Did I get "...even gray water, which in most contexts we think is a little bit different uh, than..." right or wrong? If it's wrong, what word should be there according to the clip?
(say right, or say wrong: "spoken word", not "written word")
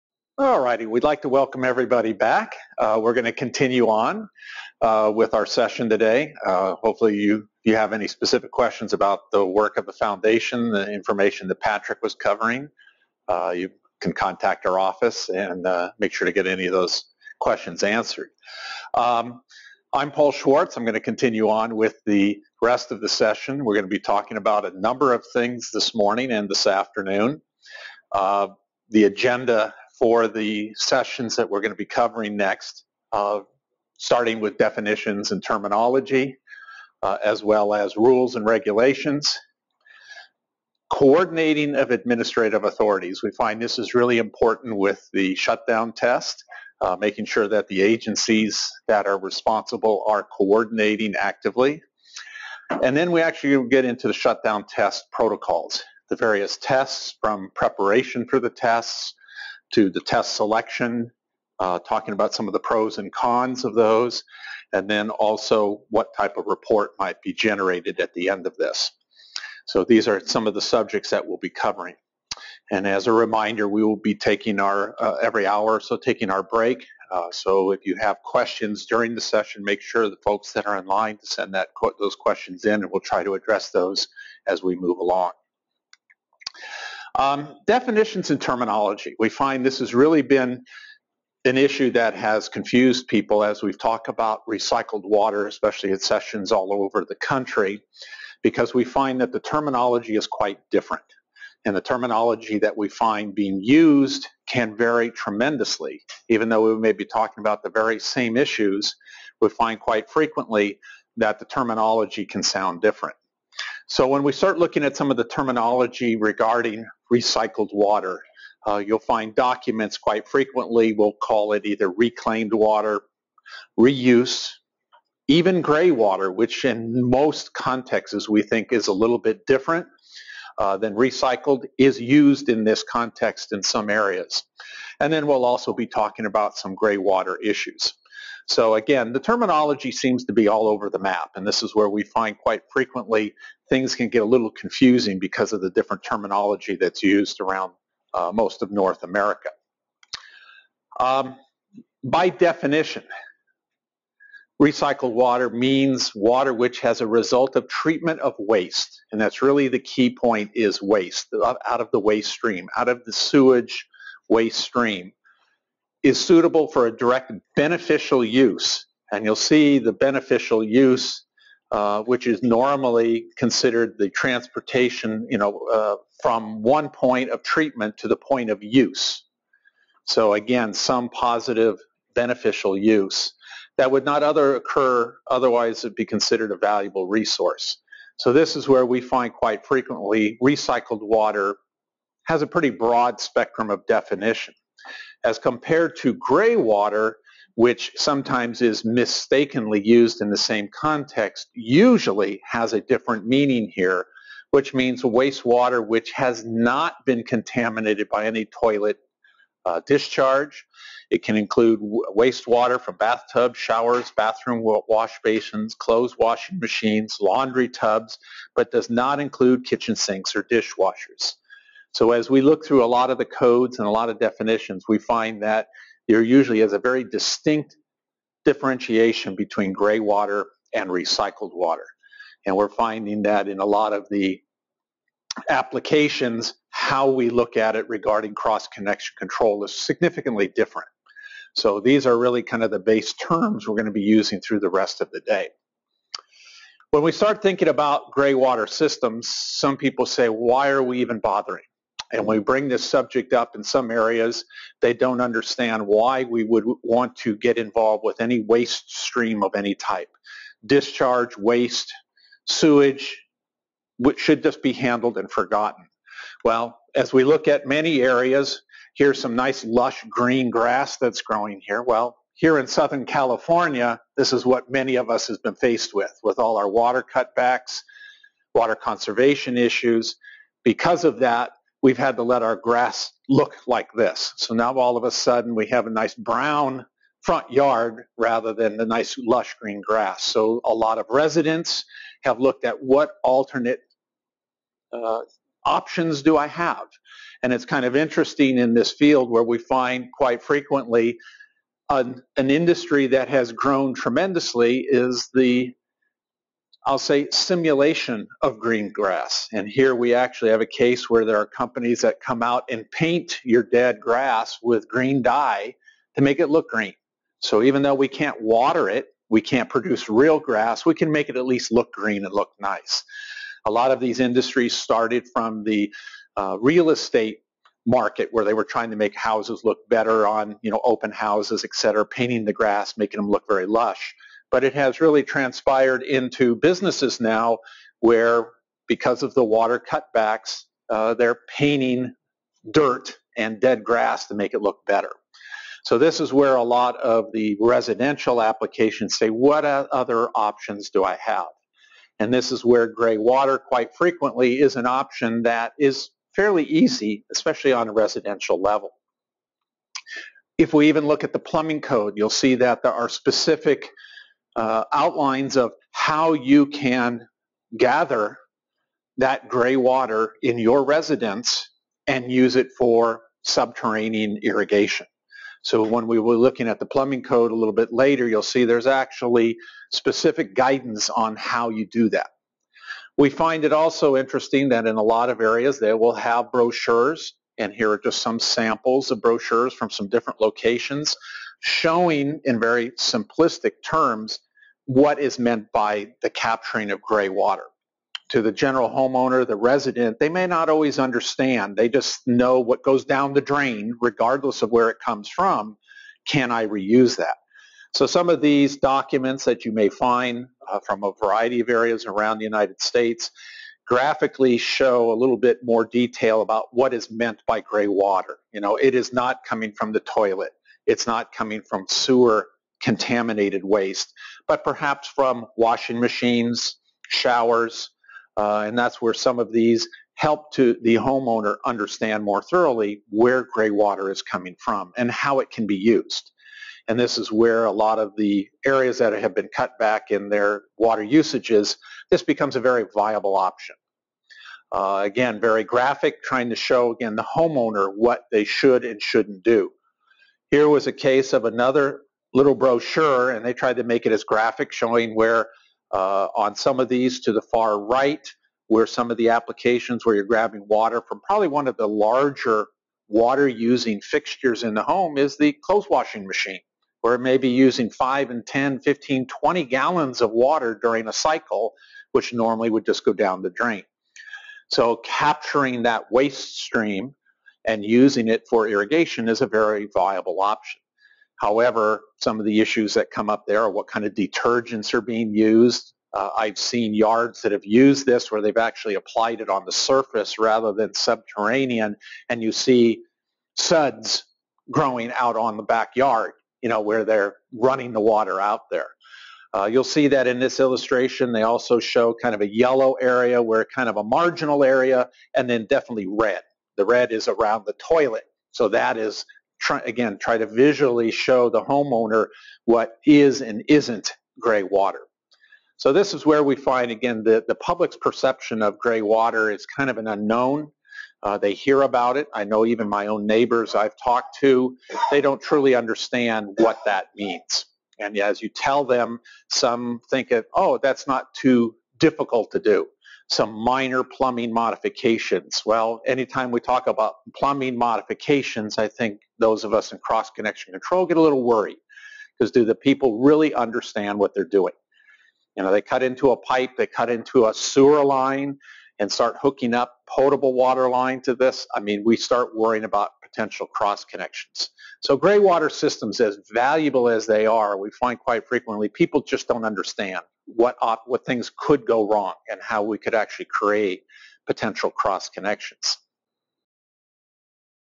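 right.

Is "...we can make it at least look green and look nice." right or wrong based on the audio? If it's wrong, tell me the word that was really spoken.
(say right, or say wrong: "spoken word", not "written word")
right.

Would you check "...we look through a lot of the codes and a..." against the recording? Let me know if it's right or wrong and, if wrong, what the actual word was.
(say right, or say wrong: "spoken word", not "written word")
right.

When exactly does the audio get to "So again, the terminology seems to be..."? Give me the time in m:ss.
2:18.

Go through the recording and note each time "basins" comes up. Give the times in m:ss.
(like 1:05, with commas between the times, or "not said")
3:35.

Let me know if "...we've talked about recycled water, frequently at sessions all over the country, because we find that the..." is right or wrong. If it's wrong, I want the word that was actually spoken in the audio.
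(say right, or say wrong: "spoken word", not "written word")
wrong: "especially", not "frequently".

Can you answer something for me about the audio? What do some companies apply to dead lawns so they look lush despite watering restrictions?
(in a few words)
green dye.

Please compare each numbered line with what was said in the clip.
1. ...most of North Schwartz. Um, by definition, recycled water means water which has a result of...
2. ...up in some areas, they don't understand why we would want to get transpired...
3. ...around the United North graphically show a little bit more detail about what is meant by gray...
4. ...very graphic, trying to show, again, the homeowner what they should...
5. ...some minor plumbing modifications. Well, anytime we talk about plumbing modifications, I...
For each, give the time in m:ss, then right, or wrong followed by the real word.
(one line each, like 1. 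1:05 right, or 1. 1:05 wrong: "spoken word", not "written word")
1. 2:28 wrong: "America", not "Schwartz"
2. 4:13 wrong: "involved", not "transpired"
3. 6:52 wrong: "States", not "North"
4. 7:25 right
5. 8:53 right.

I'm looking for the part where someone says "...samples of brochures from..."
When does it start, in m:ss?
6:28.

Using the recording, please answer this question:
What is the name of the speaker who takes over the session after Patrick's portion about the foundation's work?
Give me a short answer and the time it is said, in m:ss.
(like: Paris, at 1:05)
Paul Schwartz, at 0:20.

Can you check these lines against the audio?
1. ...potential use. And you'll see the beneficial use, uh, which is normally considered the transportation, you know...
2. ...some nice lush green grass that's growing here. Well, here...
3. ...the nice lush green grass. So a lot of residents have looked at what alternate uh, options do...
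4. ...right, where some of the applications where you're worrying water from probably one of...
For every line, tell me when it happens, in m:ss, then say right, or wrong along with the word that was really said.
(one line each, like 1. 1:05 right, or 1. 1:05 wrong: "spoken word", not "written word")
1. 2:47 wrong: "beneficial", not "potential"
2. 4:29 right
3. 4:48 right
4. 7:37 wrong: "grabbing", not "worrying".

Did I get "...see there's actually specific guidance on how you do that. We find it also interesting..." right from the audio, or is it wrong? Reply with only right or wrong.
right.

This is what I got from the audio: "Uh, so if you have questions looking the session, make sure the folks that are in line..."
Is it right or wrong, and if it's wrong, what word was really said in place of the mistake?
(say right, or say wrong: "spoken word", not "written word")
wrong: "during", not "looking".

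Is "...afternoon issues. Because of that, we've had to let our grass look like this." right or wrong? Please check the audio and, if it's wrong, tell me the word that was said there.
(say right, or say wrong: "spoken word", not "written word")
wrong: "conservation", not "afternoon".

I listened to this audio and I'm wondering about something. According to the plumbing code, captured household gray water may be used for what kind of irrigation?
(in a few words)
subterranean irrigation.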